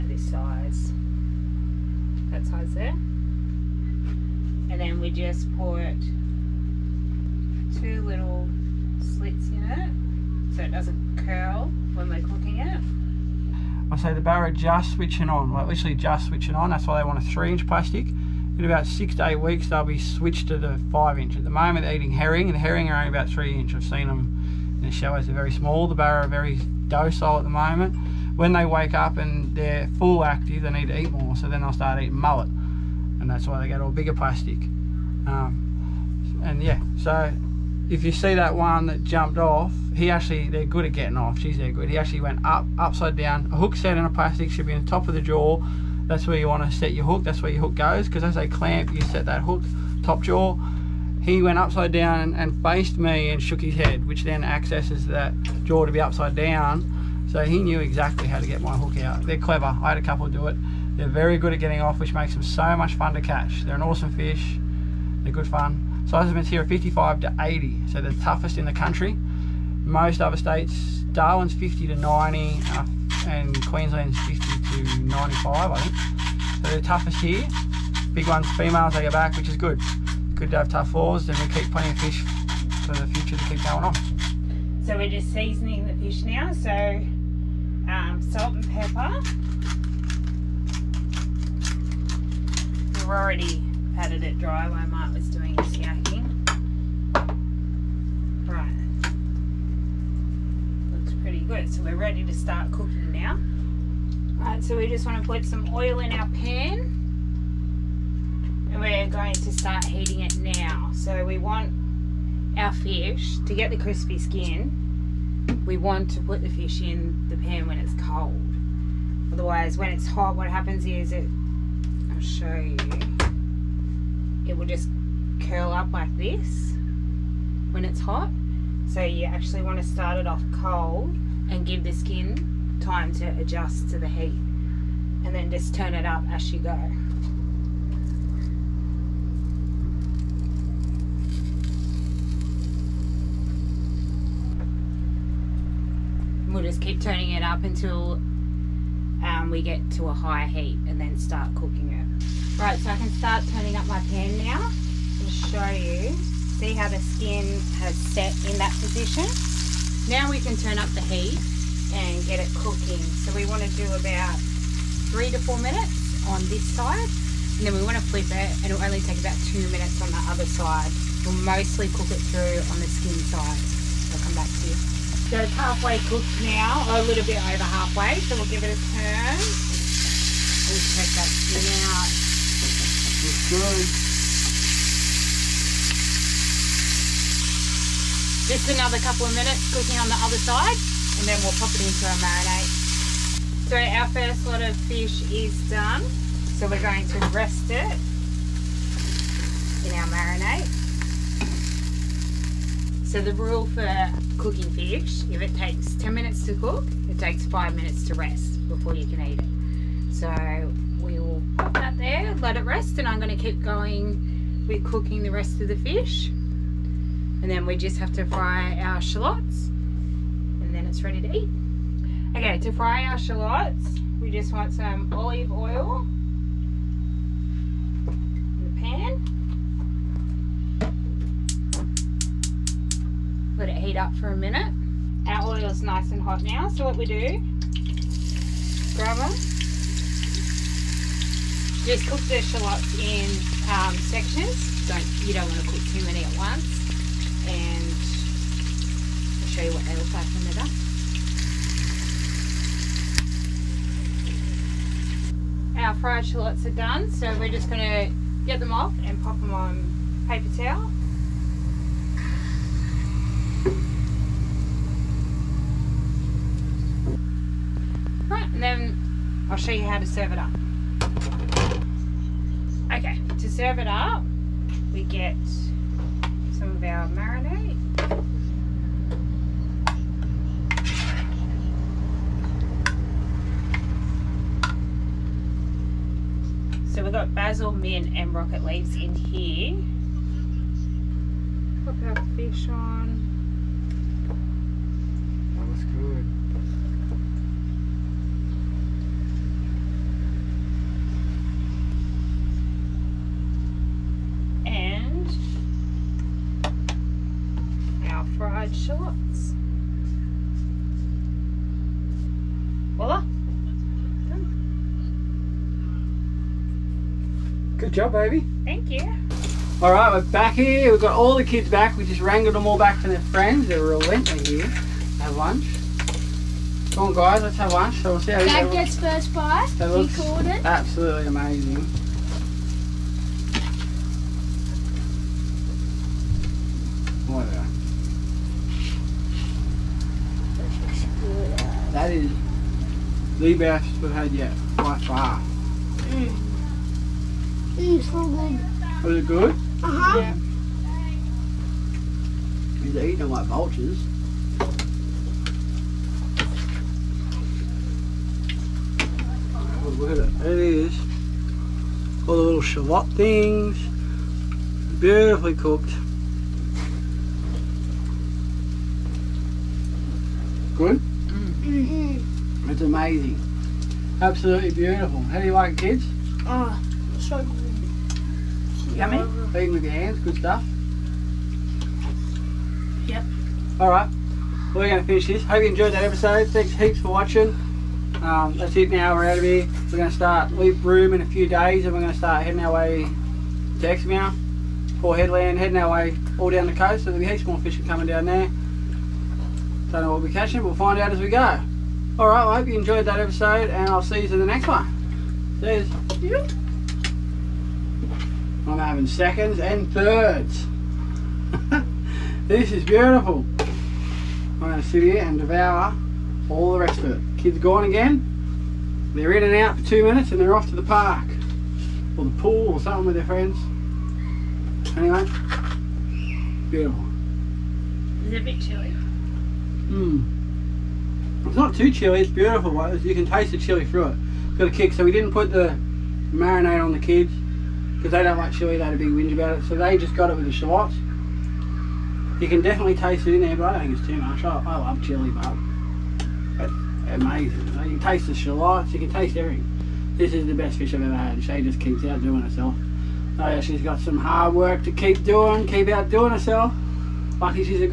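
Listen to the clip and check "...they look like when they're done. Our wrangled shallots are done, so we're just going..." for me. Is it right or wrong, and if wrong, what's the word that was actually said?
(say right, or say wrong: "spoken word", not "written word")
wrong: "fried", not "wrangled".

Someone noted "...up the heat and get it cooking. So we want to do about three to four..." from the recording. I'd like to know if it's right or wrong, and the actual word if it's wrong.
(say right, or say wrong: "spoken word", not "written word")
right.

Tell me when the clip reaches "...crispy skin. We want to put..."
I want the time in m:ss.
1:53.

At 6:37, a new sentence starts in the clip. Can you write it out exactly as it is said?
So there'll be heaps more fishing coming down there.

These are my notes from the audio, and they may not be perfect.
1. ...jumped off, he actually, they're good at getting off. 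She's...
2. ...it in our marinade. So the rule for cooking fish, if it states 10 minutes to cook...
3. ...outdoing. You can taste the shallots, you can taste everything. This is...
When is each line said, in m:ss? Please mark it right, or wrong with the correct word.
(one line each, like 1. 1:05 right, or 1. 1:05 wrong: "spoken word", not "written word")
1. 0:39 right
2. 3:17 wrong: "takes", not "states"
3. 7:27 wrong: "amazing", not "outdoing".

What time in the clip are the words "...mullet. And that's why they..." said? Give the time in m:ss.
0:32.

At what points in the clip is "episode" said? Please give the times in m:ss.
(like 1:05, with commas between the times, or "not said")
6:26, 6:43.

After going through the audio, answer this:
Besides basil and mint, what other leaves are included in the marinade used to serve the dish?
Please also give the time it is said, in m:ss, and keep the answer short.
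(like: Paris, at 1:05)
Rocket, at 4:48.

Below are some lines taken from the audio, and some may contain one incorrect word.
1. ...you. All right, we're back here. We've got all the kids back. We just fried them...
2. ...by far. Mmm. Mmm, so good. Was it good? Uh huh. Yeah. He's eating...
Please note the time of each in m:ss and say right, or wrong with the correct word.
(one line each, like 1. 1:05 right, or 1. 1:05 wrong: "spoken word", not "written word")
1. 5:18 wrong: "wrangled", not "fried"
2. 5:44 right.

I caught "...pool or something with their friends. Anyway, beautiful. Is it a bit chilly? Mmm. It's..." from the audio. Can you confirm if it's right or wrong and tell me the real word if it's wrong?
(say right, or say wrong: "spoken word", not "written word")
right.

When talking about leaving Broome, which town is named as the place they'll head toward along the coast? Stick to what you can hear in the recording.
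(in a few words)
Exmouth.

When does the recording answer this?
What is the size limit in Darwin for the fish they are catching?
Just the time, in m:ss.
1:11.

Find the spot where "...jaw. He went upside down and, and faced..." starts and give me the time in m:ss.
0:50.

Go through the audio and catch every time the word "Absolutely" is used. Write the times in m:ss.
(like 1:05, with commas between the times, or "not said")
5:30, 6:14.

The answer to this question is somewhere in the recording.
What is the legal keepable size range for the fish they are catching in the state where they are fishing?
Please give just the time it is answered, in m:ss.
1:06.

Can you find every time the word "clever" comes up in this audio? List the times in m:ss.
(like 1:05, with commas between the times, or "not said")
0:59.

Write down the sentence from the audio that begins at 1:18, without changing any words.
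Big ones, females, they go back, which is good.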